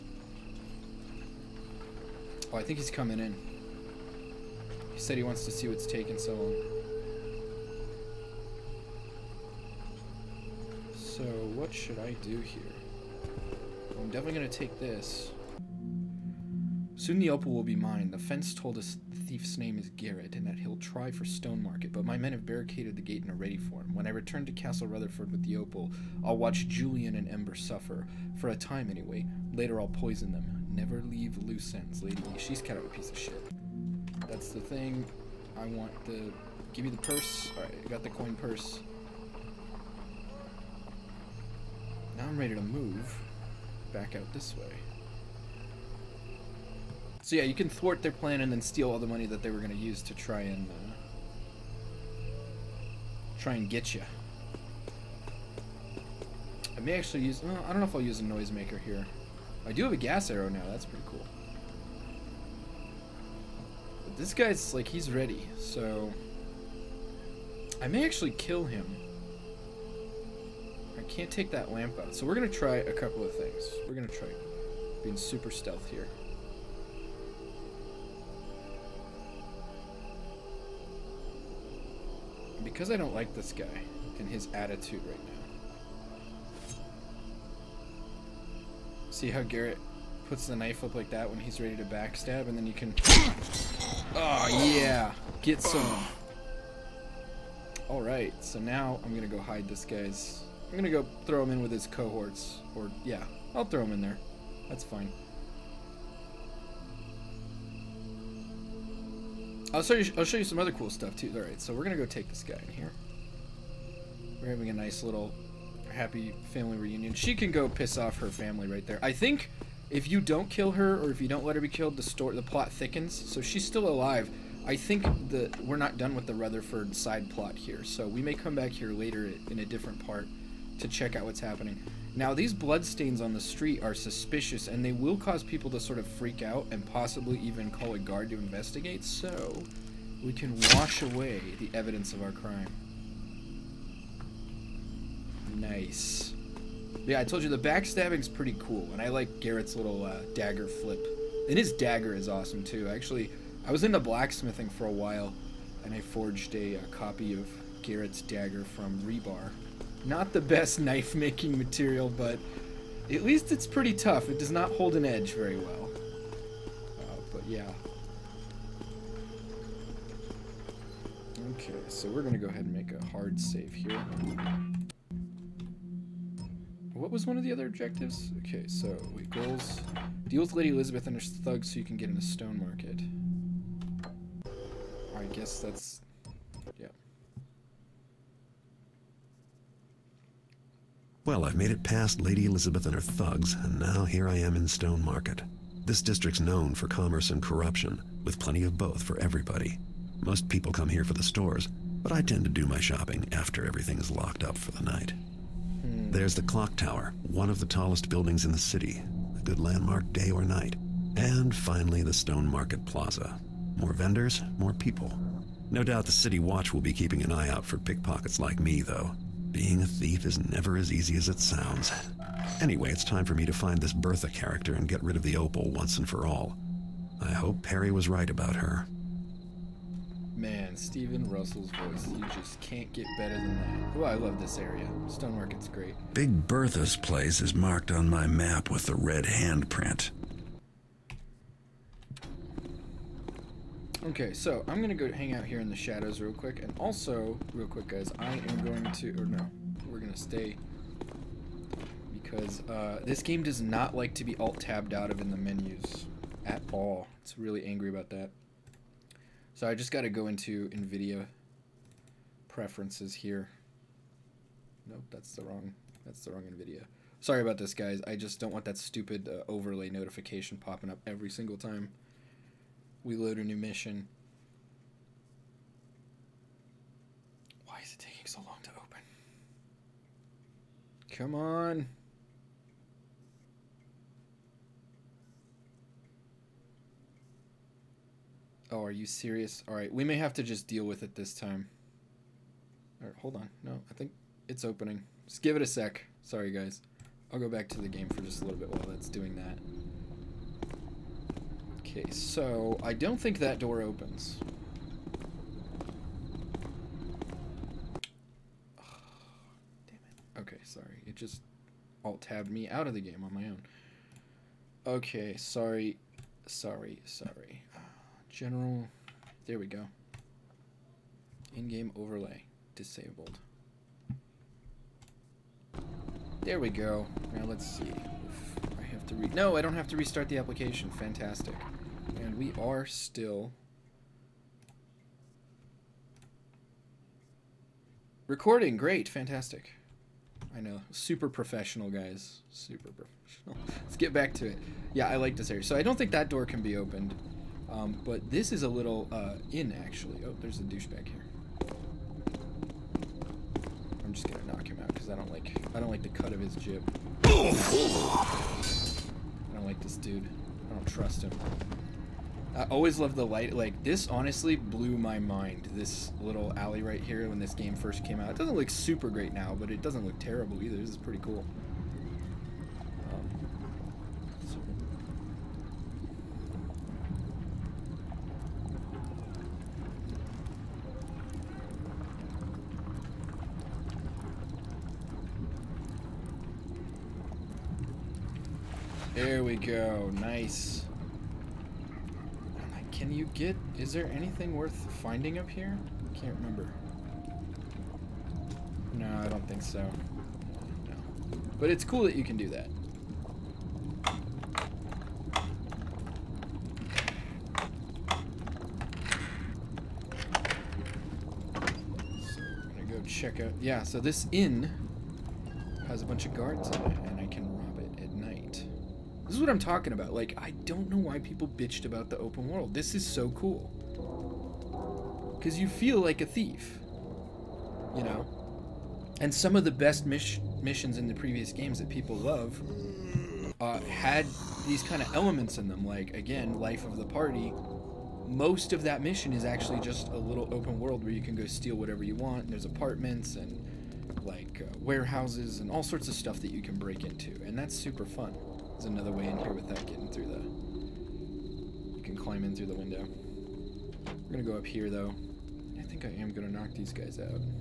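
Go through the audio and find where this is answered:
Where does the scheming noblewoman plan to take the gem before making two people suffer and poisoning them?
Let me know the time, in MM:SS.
00:24.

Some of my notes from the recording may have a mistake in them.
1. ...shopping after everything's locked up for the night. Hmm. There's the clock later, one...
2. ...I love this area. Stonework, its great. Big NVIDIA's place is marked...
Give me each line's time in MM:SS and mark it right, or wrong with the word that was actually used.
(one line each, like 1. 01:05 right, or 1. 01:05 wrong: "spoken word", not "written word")
1. 03:22 wrong: "tower", not "later"
2. 03:54 wrong: "Bertha", not "NVIDIA".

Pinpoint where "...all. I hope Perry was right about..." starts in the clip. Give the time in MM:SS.
03:46.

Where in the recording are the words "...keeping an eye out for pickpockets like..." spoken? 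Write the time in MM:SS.
03:36.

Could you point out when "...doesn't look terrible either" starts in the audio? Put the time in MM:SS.
06:09.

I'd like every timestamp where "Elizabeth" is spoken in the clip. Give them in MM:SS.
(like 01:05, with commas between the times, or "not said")
03:00, 03:12.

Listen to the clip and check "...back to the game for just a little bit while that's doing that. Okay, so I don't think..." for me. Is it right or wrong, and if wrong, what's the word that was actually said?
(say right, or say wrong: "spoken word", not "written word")
right.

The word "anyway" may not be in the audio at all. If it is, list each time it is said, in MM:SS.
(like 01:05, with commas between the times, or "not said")
00:28, 03:42.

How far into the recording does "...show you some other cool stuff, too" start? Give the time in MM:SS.
01:50.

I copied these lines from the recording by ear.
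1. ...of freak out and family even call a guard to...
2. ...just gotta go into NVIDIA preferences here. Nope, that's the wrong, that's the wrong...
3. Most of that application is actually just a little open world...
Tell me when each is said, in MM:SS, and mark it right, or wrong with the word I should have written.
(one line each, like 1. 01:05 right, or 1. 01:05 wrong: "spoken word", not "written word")
1. 02:15 wrong: "possibly", not "family"
2. 04:19 right
3. 07:18 wrong: "mission", not "application".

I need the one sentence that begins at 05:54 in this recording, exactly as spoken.
I'm just gonna knock him out because I don't like I don't like the cut of his jib.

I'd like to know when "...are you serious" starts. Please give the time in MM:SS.
04:48.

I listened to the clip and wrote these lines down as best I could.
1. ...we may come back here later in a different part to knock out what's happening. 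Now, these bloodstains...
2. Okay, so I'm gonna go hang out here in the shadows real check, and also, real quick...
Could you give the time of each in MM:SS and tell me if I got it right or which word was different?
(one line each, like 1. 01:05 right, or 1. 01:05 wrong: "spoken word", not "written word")
1. 02:08 wrong: "check", not "knock"
2. 04:04 wrong: "quick", not "check".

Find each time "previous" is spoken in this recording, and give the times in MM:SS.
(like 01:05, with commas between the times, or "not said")
07:11.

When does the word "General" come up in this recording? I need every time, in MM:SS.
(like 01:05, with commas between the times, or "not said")
05:18.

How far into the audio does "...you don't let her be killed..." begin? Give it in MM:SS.
02:01.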